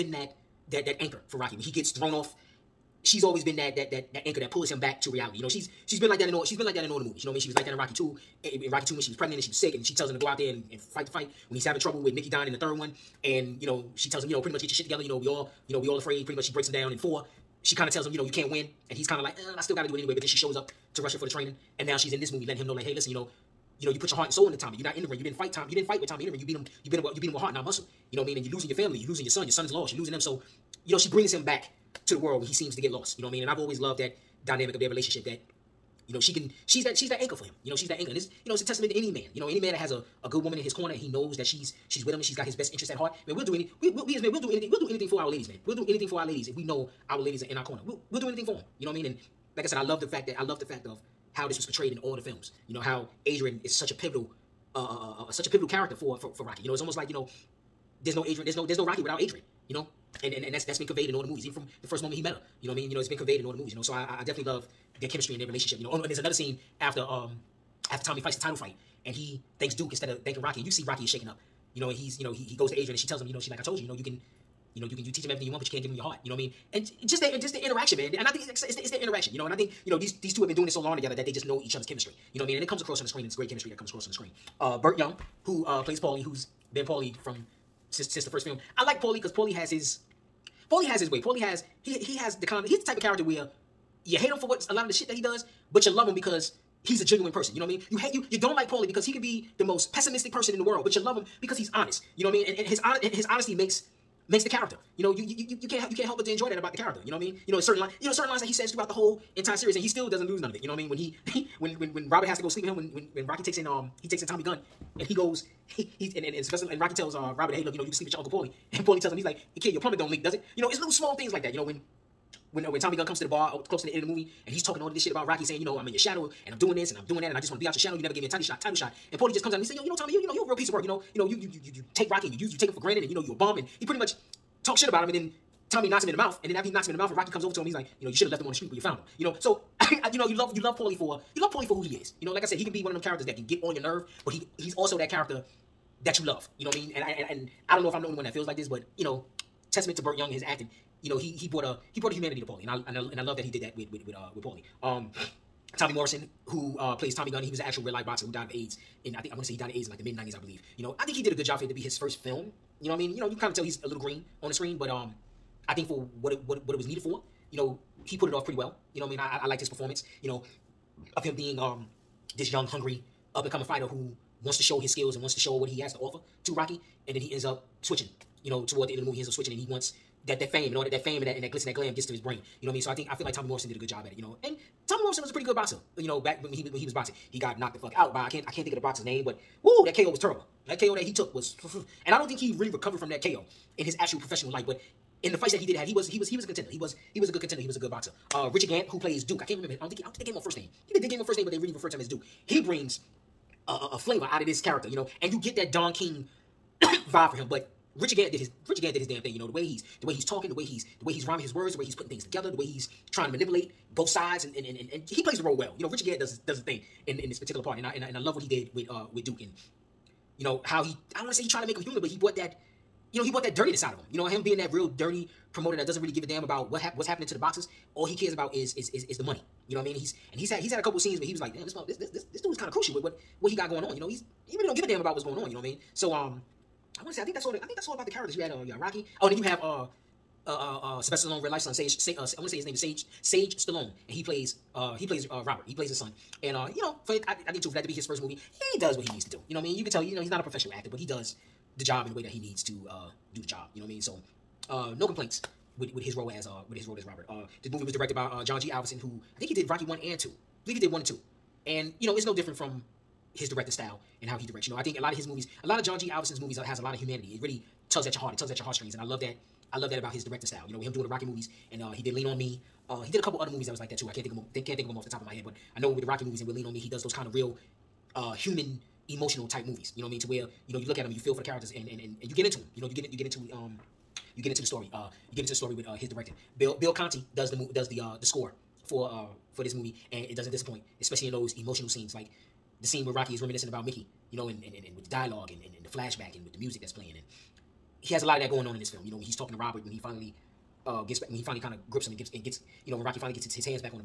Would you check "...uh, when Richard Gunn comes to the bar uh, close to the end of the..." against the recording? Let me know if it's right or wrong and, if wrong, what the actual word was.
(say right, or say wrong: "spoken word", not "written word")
wrong: "Tommy", not "Richard".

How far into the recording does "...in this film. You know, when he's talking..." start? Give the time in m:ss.
4:58.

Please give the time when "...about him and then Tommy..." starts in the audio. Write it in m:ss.
2:14.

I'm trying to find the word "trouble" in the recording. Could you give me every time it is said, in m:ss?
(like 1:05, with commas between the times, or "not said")
0:11.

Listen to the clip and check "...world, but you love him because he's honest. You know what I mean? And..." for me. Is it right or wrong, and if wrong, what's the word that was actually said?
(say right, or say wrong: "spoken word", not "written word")
right.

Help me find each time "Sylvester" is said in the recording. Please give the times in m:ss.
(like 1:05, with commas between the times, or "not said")
1:56, 4:01.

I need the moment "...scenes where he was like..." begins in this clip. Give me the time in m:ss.
3:50.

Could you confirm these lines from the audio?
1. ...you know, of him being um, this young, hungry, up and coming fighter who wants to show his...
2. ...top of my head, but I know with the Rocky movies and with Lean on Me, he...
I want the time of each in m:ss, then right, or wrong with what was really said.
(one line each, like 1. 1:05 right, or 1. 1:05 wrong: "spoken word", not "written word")
1. 2:50 right
2. 4:35 right.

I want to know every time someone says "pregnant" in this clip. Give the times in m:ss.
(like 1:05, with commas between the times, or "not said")
0:09.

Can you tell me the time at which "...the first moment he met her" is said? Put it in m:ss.
1:01.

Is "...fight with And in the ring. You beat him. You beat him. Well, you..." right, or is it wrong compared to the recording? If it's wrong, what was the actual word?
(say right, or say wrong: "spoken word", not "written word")
wrong: "Tommy", not "And".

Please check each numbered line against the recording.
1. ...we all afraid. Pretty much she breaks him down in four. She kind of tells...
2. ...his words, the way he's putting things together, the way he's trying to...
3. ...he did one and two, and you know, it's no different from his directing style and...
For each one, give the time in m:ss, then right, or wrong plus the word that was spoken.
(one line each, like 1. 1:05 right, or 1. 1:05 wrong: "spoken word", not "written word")
1. 0:15 right
2. 3:31 right
3. 4:20 right.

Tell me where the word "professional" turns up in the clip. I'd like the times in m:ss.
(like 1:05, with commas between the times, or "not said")
3:14, 4:10.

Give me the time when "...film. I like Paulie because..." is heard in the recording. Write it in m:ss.
1:28.